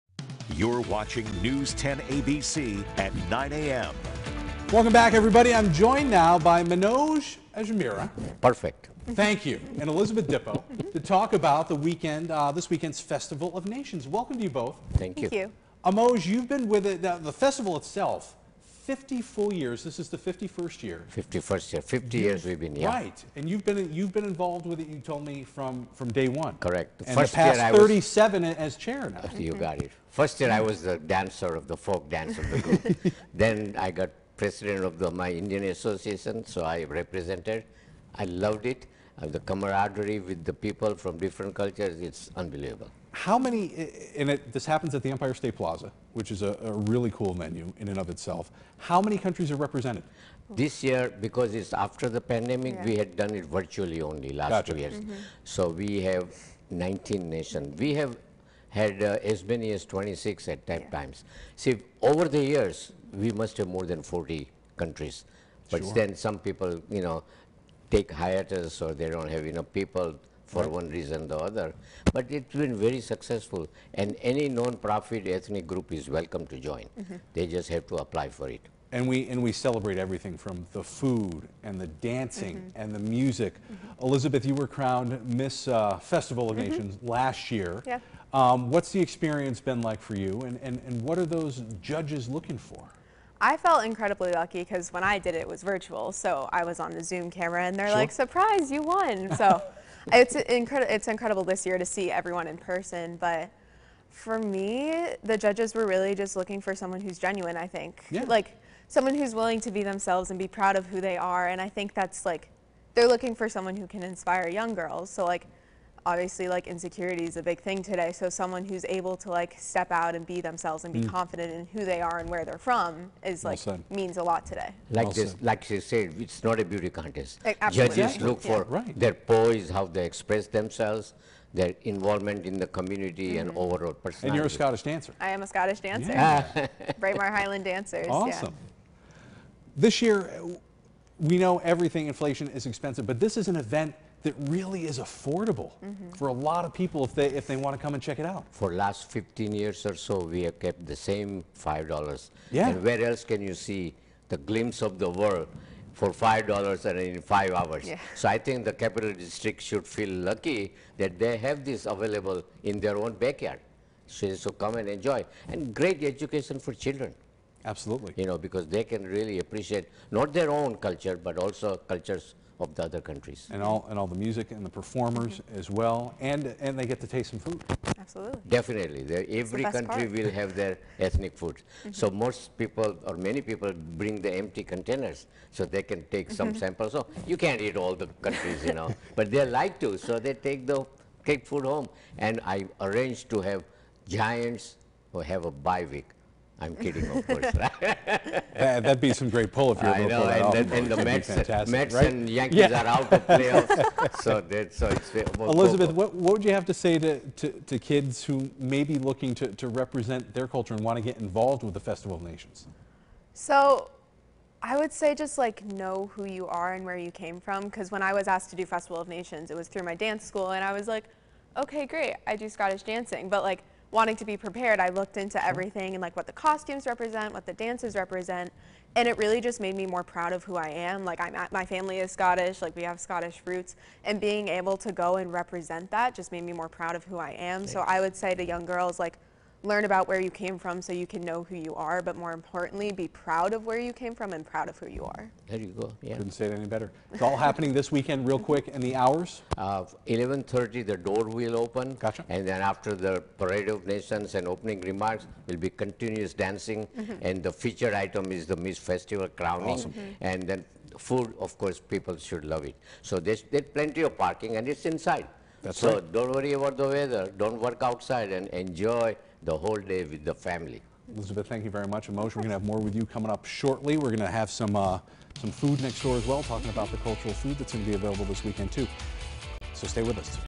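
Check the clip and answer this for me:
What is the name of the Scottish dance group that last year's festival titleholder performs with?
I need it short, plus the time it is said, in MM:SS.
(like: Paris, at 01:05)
Braemar Highland dancers, at 02:17.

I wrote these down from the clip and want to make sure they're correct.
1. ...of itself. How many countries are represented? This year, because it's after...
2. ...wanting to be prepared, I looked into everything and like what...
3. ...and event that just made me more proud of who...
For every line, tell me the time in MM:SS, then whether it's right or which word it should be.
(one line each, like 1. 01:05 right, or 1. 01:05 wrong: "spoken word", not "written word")
1. 00:47 right
2. 03:43 right
3. 03:55 wrong: "represent", not "event".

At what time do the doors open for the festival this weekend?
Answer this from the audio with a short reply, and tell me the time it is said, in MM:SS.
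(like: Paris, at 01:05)
11:30, at 04:09.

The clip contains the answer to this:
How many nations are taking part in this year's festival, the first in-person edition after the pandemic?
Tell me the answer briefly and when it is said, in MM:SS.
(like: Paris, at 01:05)
19, at 00:56.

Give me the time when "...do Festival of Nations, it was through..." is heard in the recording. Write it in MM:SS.
03:38.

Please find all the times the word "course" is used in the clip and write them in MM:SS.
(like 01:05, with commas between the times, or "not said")
03:17, 04:21.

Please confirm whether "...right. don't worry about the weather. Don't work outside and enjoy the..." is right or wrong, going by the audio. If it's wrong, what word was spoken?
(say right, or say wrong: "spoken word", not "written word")
right.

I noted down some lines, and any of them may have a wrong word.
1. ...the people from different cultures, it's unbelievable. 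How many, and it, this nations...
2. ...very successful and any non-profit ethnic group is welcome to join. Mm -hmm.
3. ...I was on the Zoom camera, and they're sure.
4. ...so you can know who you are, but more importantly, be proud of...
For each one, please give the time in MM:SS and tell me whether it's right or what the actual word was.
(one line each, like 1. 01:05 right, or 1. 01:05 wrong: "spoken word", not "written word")
1. 00:40 wrong: "happens", not "nations"
2. 01:12 right
3. 01:36 right
4. 04:00 right.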